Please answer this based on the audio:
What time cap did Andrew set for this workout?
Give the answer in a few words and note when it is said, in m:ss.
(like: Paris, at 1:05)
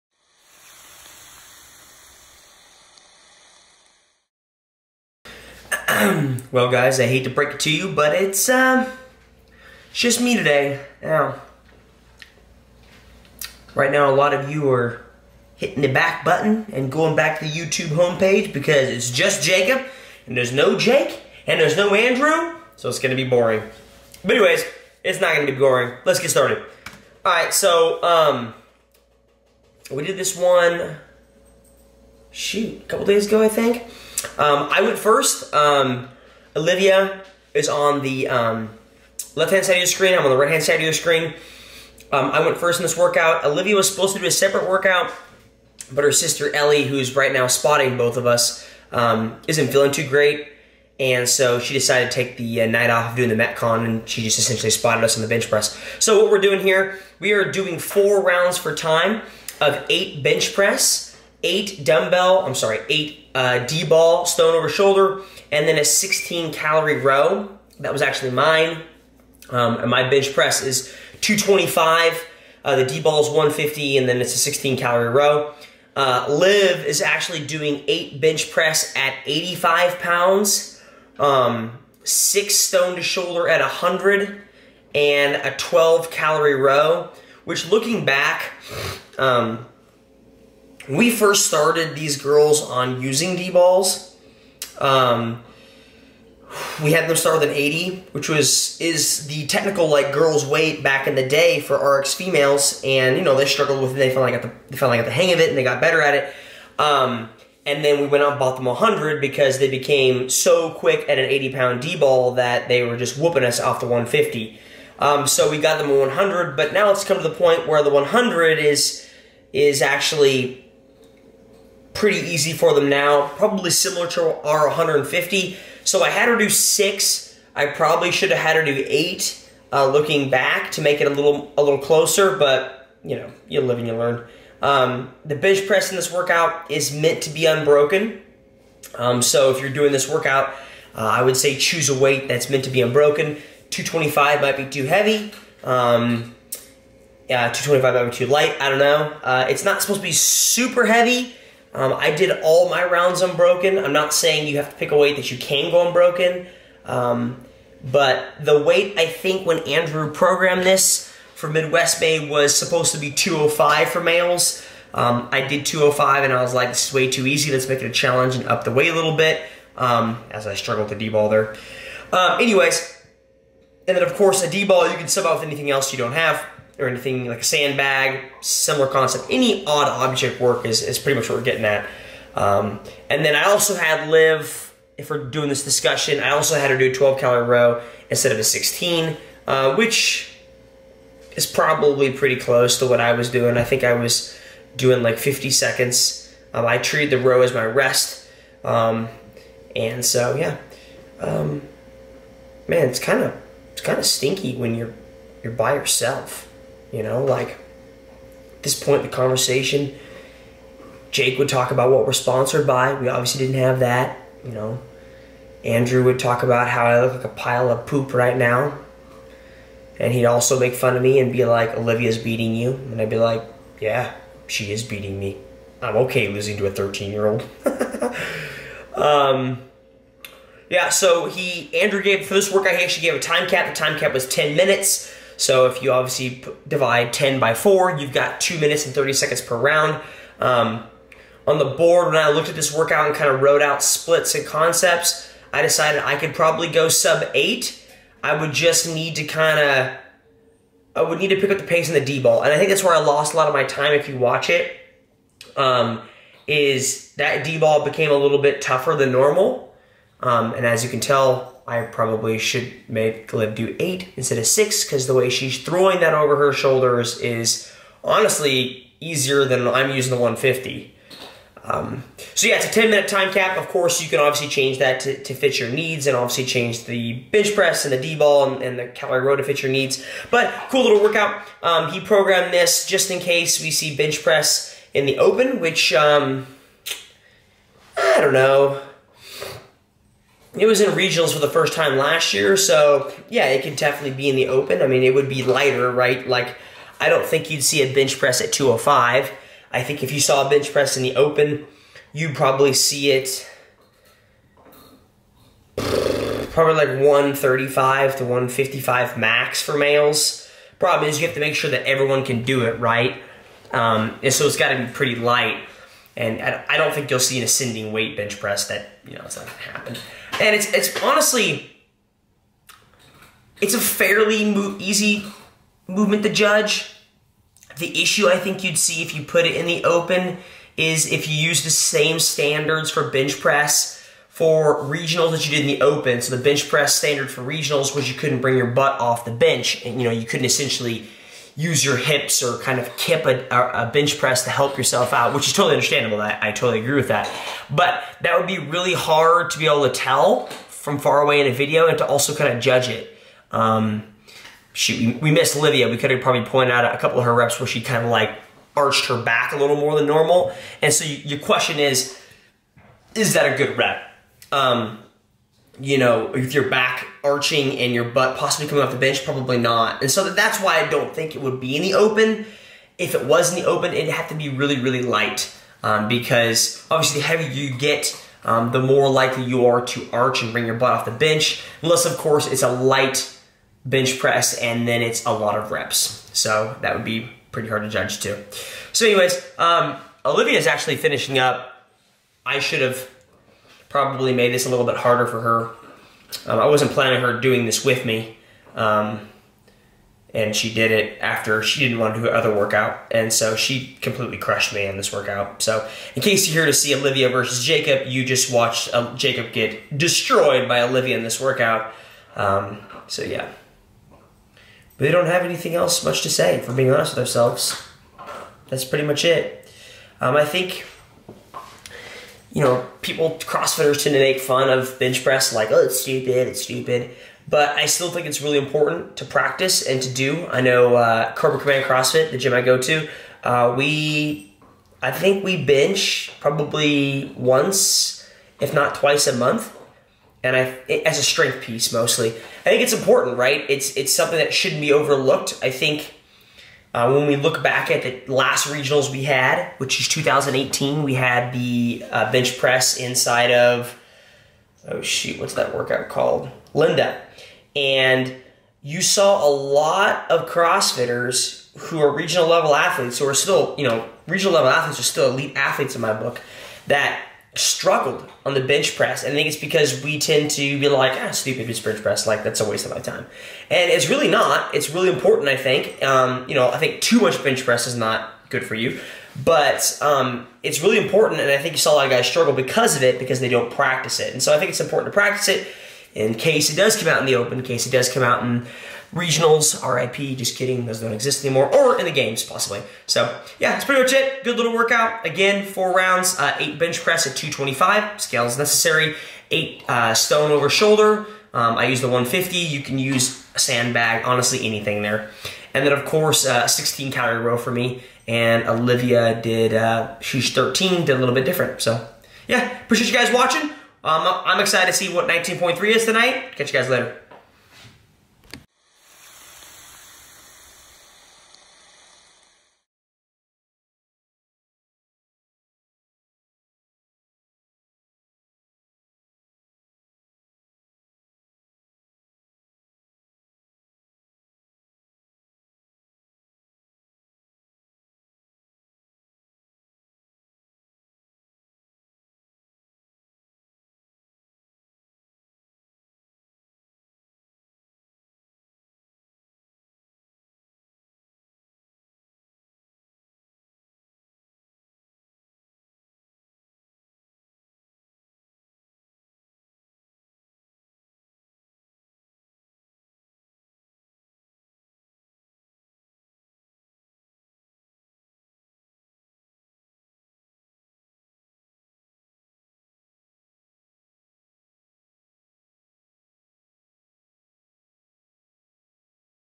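10 minutes, at 3:53.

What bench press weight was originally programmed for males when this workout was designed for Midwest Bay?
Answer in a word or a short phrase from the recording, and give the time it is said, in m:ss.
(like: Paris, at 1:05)
205, at 2:42.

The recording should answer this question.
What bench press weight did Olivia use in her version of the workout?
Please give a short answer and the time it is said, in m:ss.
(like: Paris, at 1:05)
85 pounds, at 1:19.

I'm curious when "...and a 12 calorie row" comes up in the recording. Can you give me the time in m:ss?
1:24.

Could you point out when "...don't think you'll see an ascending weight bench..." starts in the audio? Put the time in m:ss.
5:16.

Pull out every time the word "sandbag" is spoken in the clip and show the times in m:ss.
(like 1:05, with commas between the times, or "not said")
2:57, 8:23.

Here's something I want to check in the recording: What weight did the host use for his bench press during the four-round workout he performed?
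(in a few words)
225 pounds.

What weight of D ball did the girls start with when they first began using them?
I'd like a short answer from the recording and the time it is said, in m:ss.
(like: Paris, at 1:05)
80, at 1:37.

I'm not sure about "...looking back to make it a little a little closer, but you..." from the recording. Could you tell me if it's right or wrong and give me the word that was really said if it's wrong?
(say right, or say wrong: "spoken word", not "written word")
right.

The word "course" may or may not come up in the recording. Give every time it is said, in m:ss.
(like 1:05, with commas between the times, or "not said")
2:54, 4:33, 6:22, 8:26.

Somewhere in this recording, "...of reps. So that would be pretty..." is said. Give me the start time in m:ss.
6:25.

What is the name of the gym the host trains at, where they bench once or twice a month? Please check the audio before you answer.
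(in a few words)
Cobra Command CrossFit.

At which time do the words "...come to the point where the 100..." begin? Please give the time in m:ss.
1:57.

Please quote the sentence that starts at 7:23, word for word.
It's it's something that shouldn't be overlooked.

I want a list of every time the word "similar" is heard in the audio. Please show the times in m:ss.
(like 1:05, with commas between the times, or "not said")
2:03, 2:58.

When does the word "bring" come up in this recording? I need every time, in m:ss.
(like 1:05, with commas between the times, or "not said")
5:38, 6:20.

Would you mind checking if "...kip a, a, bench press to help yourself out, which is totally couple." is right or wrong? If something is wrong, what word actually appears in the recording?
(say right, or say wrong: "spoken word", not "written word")
wrong: "understandable", not "couple".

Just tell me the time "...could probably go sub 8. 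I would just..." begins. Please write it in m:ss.
4:06.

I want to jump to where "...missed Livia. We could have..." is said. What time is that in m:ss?
5:55.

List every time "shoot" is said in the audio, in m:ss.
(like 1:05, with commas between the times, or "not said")
0:32, 5:54, 7:35.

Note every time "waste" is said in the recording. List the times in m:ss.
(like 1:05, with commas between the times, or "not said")
7:52.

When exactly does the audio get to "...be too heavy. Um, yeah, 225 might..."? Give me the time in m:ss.
2:24.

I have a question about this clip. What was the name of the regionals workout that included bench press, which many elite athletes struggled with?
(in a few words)
Linda.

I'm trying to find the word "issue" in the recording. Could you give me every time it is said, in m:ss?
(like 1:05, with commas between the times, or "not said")
5:28.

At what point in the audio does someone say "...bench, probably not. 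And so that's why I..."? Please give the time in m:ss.
6:08.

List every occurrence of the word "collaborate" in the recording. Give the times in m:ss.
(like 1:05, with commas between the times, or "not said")
not said.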